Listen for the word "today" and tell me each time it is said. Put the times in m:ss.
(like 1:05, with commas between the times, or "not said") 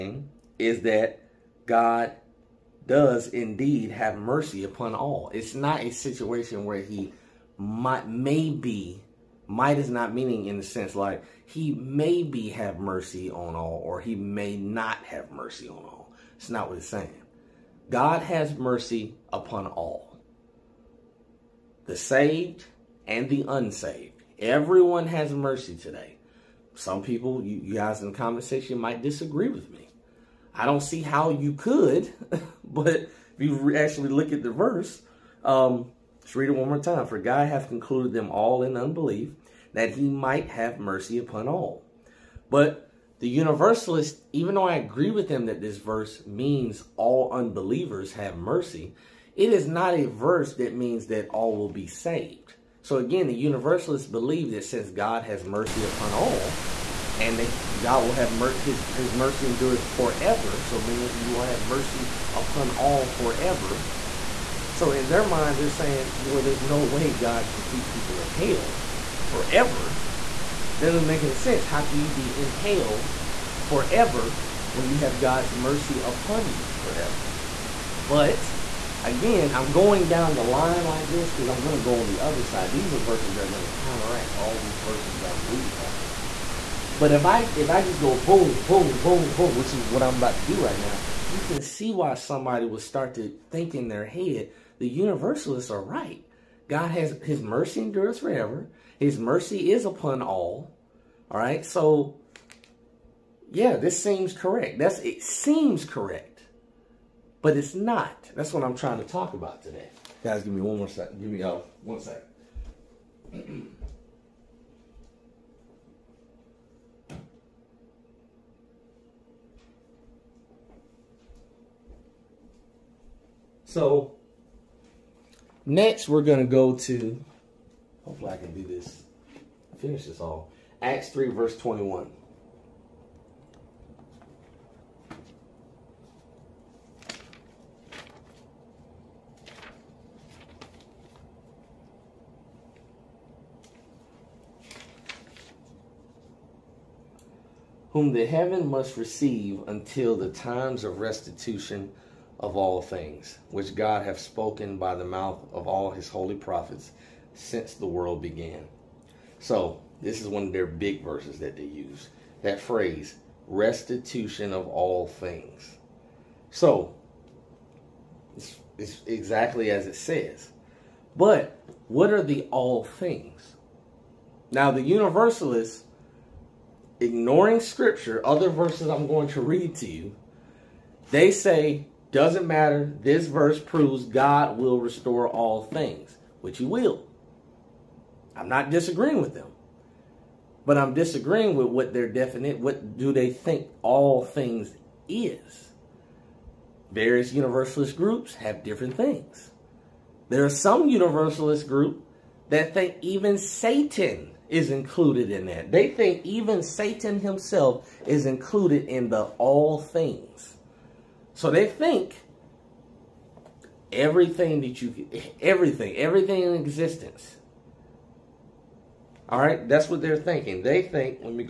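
0:25, 1:49.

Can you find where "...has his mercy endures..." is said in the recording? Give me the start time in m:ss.
1:36.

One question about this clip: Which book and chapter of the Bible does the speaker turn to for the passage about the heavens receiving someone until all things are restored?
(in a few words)
Acts 3.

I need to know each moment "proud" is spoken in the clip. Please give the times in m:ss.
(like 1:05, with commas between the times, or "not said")
not said.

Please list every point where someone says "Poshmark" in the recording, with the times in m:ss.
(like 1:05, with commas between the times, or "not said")
not said.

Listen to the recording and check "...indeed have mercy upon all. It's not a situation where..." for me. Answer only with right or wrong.
right.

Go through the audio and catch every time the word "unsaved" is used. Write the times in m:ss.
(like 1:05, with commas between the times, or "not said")
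0:23.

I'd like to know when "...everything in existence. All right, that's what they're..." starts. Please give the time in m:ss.
3:35.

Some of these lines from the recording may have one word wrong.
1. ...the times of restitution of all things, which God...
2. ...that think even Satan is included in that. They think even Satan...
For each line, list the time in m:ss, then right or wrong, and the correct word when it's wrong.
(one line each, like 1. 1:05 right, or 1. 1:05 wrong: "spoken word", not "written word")
1. 2:30 right
2. 3:22 right.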